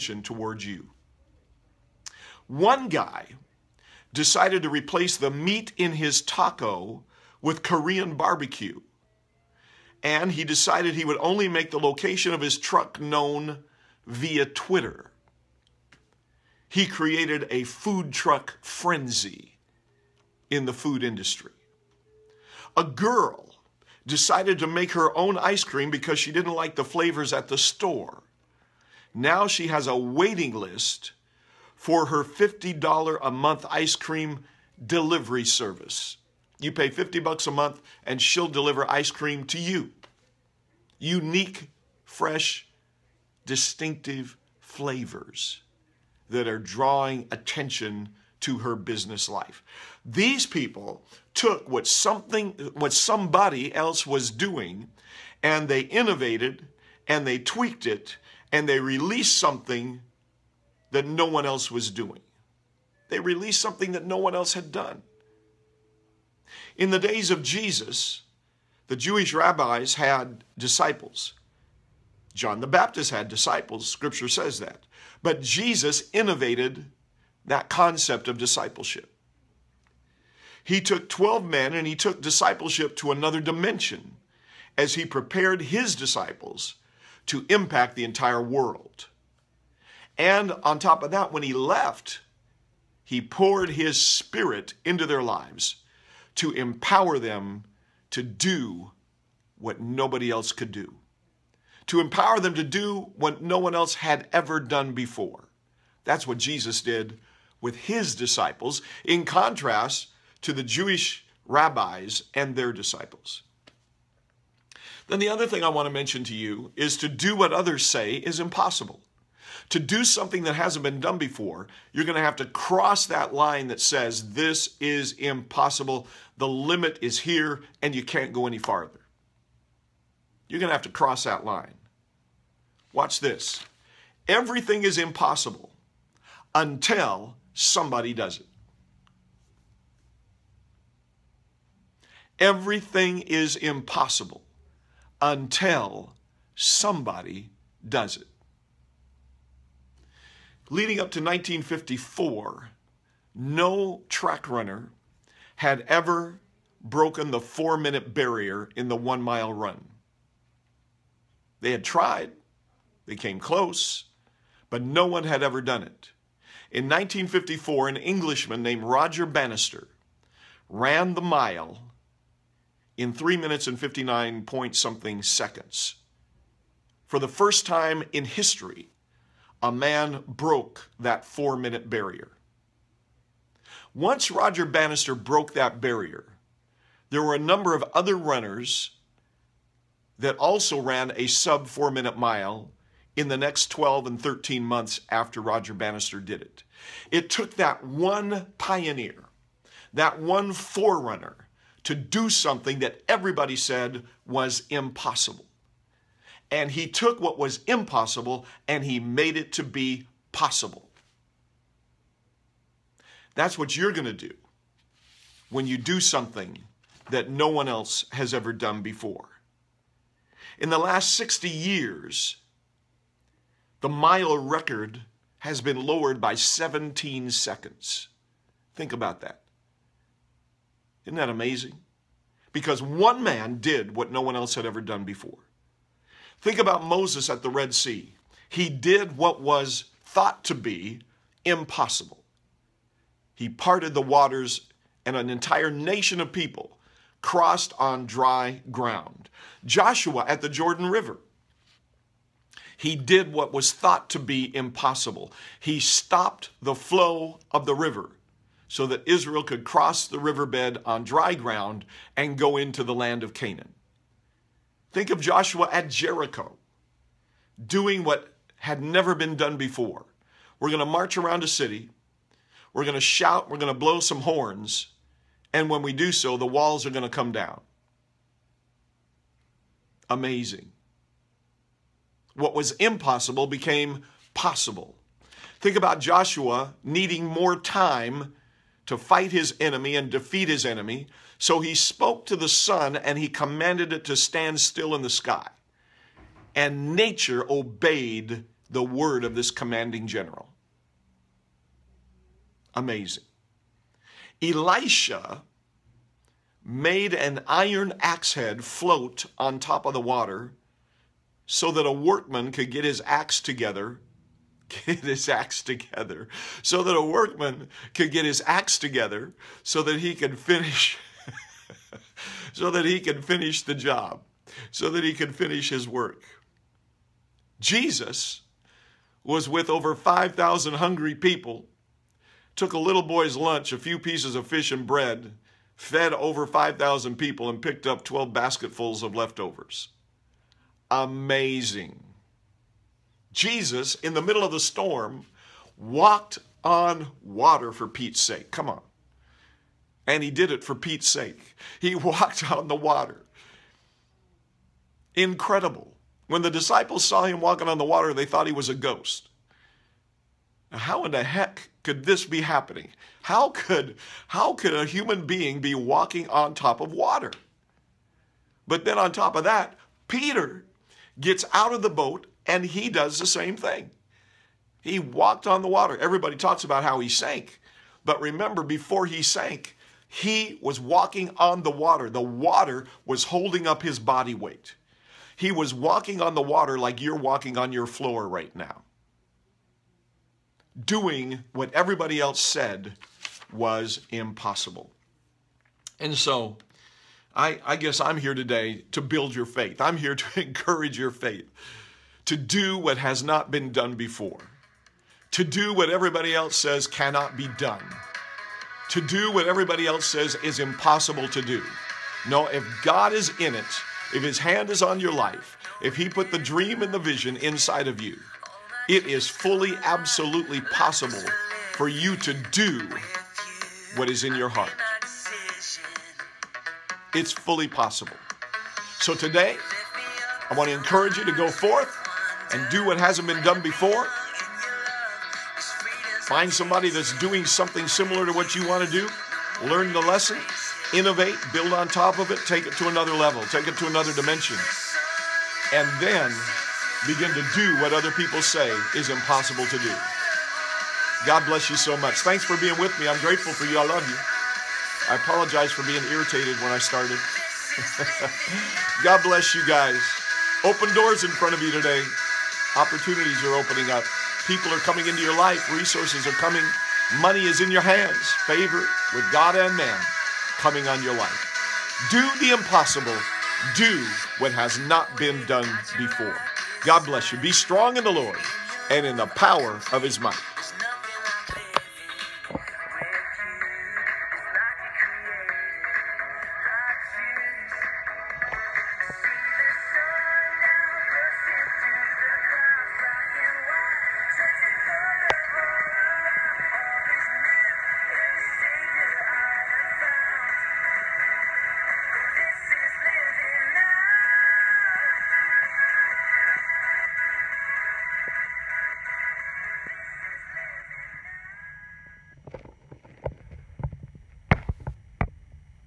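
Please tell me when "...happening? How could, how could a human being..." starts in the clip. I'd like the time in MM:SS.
06:02.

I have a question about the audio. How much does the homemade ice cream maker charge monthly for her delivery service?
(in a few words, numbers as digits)
$50.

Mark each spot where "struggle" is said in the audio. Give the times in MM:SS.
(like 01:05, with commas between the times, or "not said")
not said.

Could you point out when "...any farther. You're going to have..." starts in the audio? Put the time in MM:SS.
02:08.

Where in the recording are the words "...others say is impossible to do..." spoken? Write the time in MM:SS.
01:57.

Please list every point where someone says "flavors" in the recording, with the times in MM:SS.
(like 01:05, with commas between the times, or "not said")
00:26, 00:44.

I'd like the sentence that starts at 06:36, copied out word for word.
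And so I, I guess I'm here today to build your faith.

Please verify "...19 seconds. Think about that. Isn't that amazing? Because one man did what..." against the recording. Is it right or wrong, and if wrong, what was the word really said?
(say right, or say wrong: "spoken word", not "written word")
wrong: "17", not "19".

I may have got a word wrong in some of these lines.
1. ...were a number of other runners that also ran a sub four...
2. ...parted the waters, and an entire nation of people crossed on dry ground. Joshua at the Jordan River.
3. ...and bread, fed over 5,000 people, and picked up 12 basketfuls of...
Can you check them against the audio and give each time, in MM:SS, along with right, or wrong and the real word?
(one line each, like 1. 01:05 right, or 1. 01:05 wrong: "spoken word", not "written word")
1. 03:07 right
2. 04:03 right
3. 05:34 right.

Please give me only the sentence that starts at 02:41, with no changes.
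They had tried, they came close, but no one had ever done it.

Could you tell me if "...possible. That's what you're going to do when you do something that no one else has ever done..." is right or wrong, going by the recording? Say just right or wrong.
right.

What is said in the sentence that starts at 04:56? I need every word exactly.
And nature obeyed the word of this commanding general.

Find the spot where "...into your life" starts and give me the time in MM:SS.
07:45.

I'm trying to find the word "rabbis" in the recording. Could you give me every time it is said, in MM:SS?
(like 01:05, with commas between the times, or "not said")
01:09, 01:51.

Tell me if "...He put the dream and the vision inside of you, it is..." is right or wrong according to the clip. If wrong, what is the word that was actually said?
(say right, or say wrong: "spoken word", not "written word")
right.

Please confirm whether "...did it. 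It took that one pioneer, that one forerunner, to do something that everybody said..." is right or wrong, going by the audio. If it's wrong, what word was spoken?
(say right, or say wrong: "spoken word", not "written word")
right.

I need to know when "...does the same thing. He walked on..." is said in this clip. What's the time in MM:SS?
06:12.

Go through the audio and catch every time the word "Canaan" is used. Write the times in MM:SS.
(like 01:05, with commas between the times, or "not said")
04:23.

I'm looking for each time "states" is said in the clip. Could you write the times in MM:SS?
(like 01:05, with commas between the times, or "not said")
not said.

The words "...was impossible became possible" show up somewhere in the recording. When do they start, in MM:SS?
04:42.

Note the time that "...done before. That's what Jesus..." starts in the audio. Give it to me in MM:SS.
01:44.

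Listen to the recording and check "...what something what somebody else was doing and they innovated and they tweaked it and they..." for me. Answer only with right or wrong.
right.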